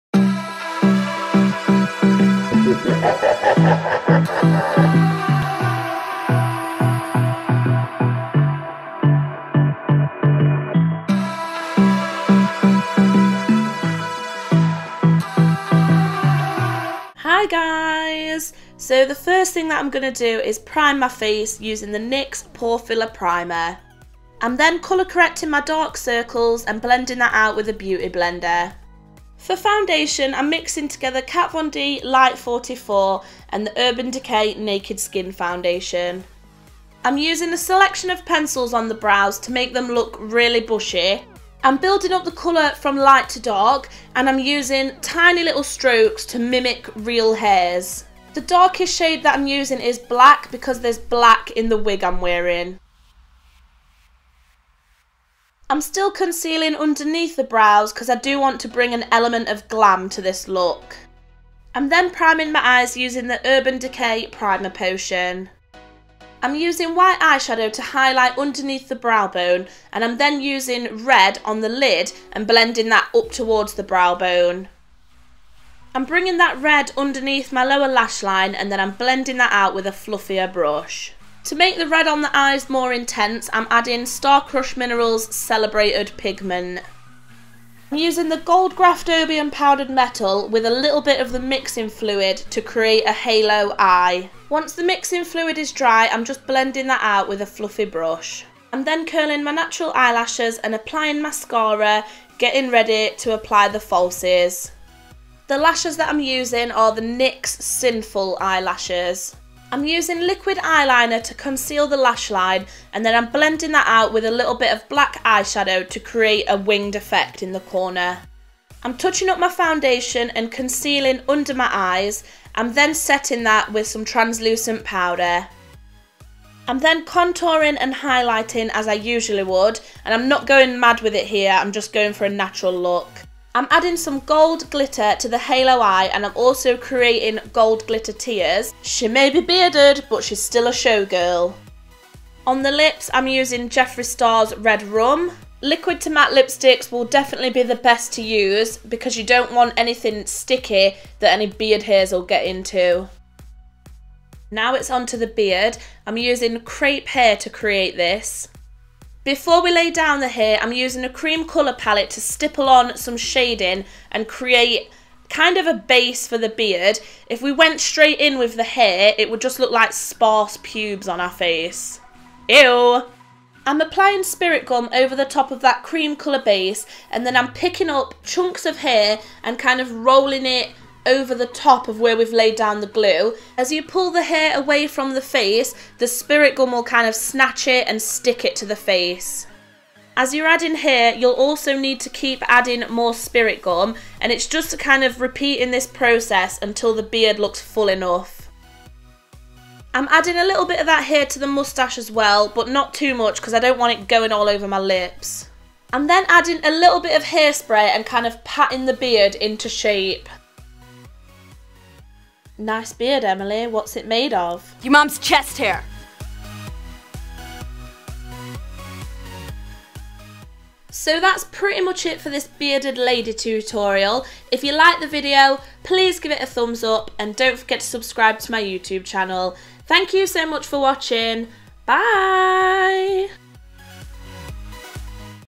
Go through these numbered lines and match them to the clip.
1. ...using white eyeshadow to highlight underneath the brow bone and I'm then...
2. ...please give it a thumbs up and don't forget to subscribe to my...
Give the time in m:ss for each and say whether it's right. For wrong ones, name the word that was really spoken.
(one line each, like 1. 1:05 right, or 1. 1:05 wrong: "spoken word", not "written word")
1. 1:06 right
2. 3:45 right.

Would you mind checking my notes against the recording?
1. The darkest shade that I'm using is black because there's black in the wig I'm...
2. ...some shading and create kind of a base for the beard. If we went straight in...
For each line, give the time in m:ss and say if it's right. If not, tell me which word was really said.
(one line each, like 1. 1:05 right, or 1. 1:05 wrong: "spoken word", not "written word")
1. 0:48 right
2. 2:42 right.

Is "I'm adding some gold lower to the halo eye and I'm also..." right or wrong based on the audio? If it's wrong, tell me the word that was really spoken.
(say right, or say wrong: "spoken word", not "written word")
wrong: "glitter", not "lower".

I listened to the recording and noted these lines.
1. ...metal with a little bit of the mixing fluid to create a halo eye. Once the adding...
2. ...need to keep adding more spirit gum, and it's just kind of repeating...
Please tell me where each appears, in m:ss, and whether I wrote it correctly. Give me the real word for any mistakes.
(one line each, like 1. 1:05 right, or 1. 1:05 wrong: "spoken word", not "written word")
1. 1:29 wrong: "mixing", not "adding"
2. 3:11 right.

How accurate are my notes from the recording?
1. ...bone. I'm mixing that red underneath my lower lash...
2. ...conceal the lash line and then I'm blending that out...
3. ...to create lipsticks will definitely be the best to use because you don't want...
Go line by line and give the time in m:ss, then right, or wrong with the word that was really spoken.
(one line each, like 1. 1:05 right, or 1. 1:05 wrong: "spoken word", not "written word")
1. 1:14 wrong: "bringing", not "mixing"
2. 1:51 right
3. 2:26 wrong: "matte", not "create".